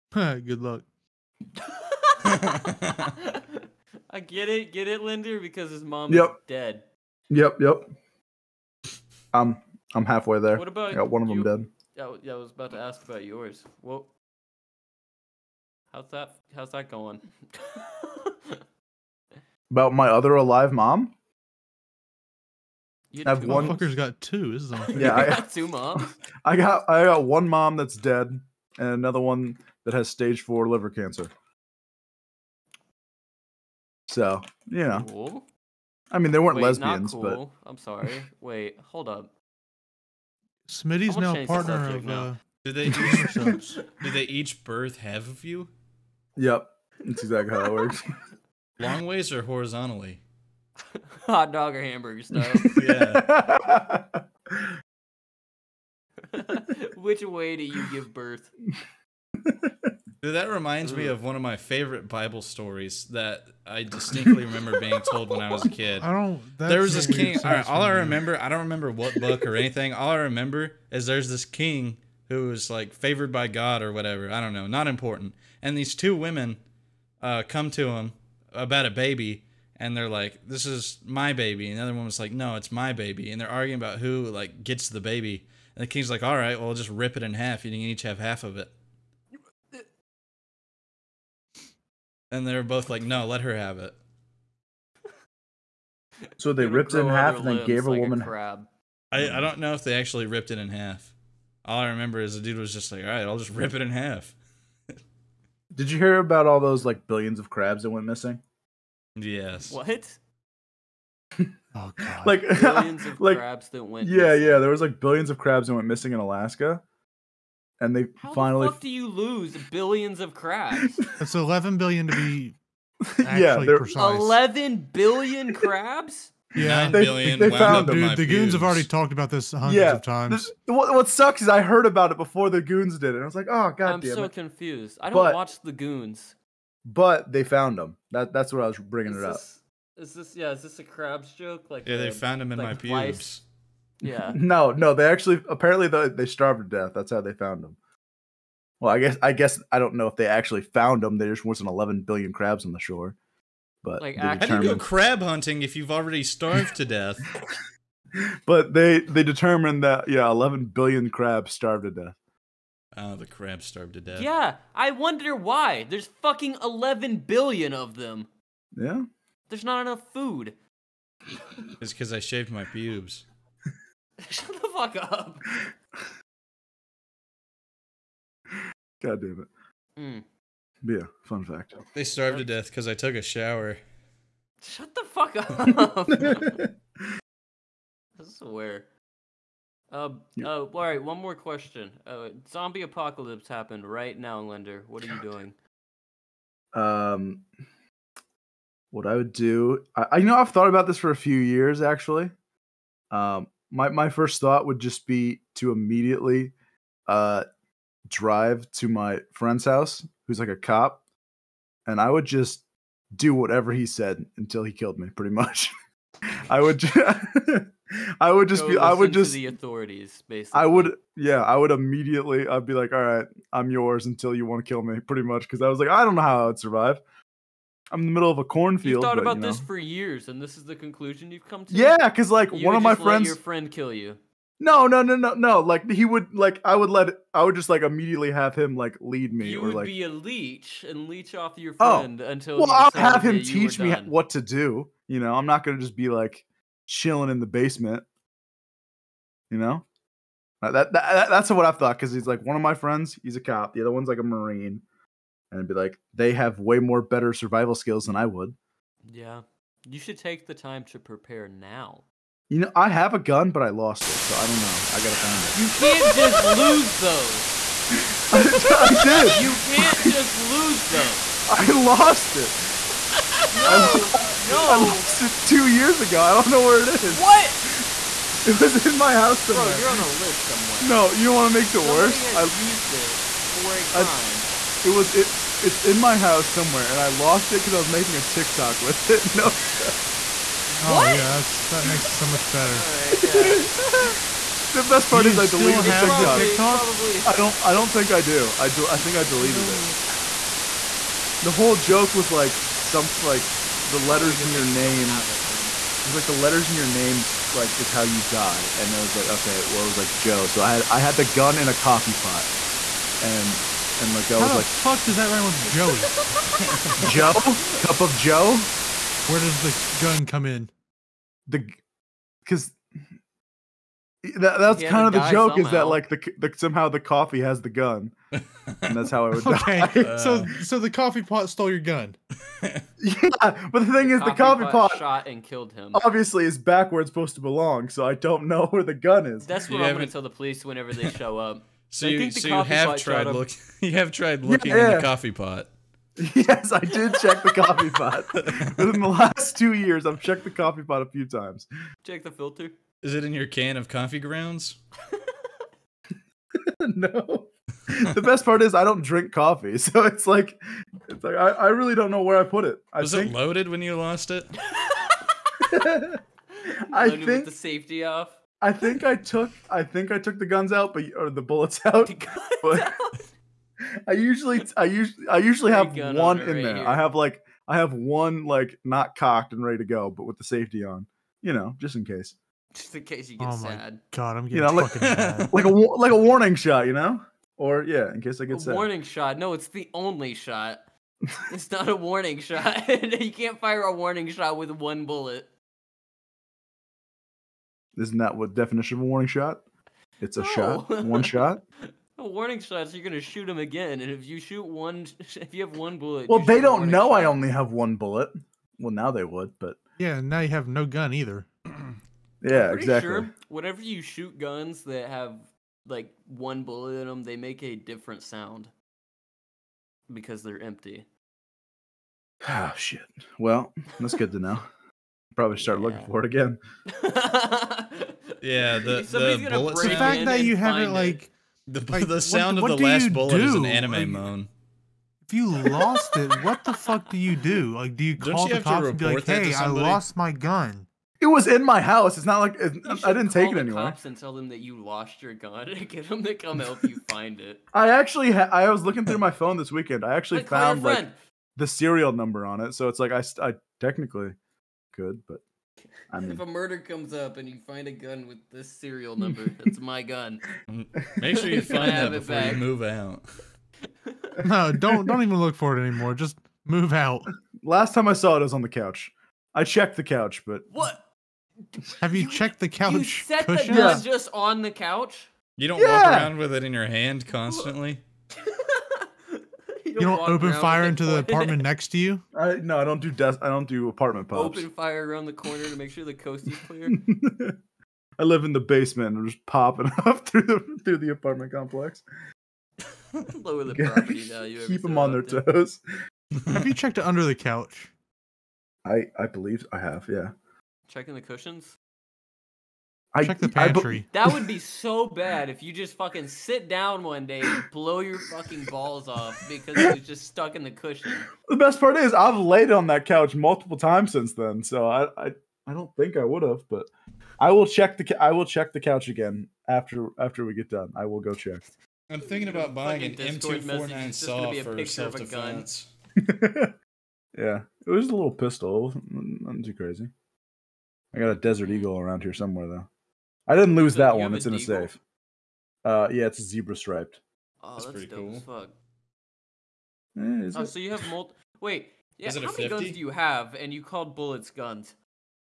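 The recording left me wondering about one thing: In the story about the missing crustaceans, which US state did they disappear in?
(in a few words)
Alaska.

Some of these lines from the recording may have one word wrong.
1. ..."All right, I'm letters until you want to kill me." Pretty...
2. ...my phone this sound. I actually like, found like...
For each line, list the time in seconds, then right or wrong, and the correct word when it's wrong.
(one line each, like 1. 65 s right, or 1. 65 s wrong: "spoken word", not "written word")
1. 222 s wrong: "yours", not "letters"
2. 449 s wrong: "weekend", not "sound".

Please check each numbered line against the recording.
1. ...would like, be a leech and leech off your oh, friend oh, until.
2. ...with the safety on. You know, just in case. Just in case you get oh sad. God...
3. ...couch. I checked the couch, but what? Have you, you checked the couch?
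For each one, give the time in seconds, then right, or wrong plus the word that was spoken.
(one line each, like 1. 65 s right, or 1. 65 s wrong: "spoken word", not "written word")
1. 239 s right
2. 380 s right
3. 468 s right.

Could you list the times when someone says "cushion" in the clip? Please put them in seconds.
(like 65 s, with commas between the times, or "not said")
473 s, 501 s, 510 s.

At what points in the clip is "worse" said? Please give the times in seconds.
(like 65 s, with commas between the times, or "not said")
281 s.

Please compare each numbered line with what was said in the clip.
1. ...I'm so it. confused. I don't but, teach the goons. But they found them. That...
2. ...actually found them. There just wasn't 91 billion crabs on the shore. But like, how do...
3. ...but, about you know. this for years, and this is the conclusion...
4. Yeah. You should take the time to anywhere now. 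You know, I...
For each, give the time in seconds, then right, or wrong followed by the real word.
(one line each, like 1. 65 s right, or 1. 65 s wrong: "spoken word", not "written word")
1. 133 s wrong: "watch", not "teach"
2. 150 s wrong: "11", not "91"
3. 229 s right
4. 259 s wrong: "prepare", not "anywhere".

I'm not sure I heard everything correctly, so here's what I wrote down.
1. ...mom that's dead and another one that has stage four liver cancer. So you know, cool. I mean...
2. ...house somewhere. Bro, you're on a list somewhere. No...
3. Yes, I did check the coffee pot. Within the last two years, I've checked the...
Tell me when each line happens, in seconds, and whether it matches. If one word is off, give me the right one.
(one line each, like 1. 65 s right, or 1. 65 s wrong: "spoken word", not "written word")
1. 27 s right
2. 279 s right
3. 346 s right.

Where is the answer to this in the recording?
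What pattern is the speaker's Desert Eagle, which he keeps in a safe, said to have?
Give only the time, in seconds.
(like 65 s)
536 s.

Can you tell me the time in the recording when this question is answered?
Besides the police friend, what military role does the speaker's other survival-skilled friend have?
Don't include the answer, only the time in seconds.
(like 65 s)
254 s.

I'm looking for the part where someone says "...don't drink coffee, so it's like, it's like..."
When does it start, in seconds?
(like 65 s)
358 s.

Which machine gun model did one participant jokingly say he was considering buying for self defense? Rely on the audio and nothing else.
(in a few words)
M249 SAW.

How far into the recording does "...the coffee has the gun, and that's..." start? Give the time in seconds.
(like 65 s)
326 s.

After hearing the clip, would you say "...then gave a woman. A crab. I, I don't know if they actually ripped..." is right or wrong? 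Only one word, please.
right.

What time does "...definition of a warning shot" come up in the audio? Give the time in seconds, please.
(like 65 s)
398 s.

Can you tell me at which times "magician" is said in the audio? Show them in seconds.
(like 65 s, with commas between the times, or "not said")
not said.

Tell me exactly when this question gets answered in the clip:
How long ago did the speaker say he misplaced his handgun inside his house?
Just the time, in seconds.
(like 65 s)
275 s.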